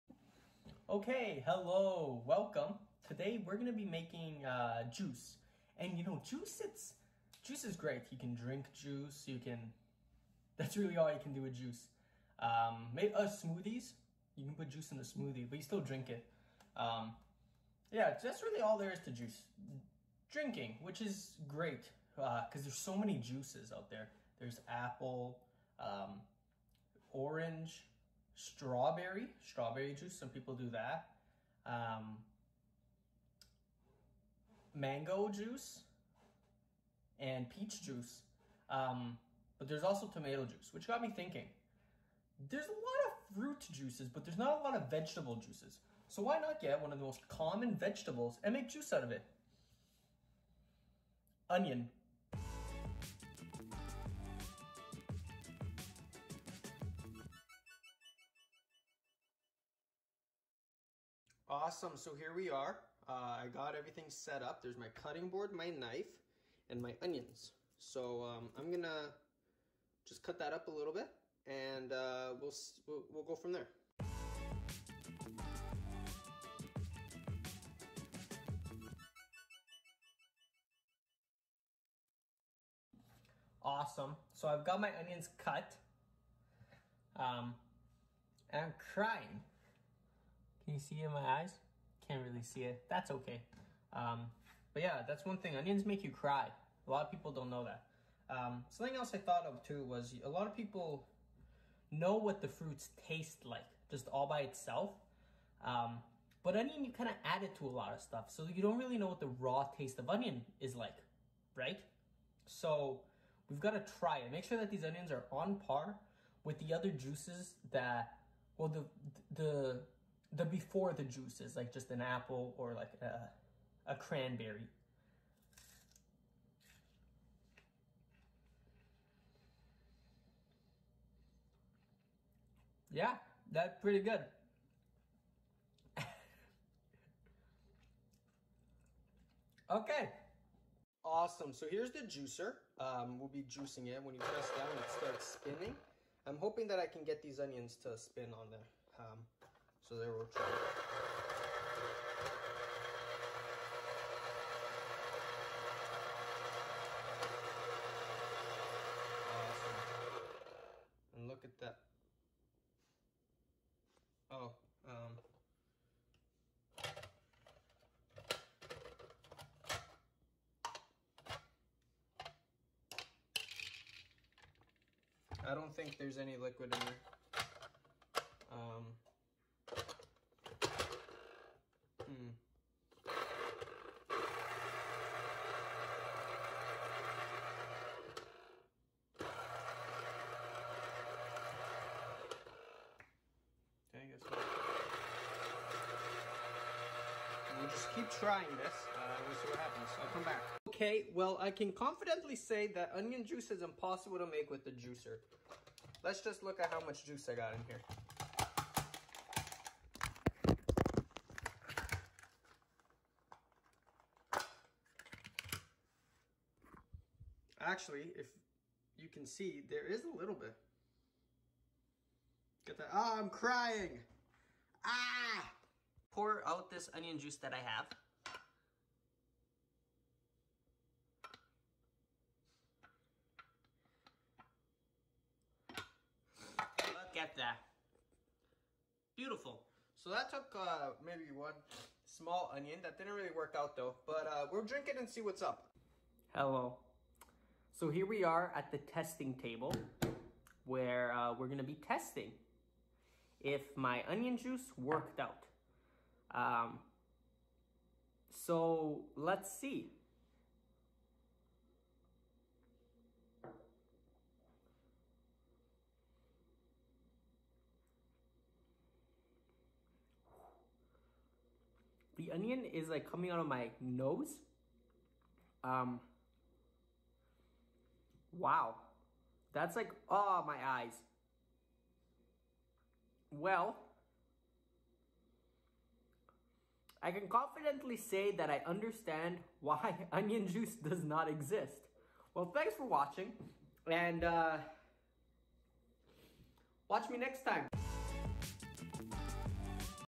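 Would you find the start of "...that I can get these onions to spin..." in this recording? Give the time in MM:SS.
02:26.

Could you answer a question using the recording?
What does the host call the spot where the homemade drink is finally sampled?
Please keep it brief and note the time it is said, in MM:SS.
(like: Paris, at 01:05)
the testing table, at 04:08.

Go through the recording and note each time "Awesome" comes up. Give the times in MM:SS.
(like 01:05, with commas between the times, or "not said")
01:01, 01:23, 02:21, 02:39.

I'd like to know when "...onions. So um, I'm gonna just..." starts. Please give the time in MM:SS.
01:07.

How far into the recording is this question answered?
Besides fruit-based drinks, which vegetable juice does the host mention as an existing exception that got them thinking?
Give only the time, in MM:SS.
00:40.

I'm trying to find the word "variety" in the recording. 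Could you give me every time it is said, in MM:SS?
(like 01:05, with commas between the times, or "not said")
not said.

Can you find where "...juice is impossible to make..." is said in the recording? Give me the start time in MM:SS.
03:23.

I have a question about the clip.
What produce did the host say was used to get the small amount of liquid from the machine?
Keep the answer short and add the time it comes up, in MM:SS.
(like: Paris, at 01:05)
one small onion, at 04:01.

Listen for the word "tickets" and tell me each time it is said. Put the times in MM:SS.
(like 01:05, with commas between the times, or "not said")
not said.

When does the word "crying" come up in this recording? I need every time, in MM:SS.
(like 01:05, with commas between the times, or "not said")
01:28, 03:43.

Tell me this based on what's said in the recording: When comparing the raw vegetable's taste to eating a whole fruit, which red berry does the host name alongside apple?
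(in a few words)
cranberry.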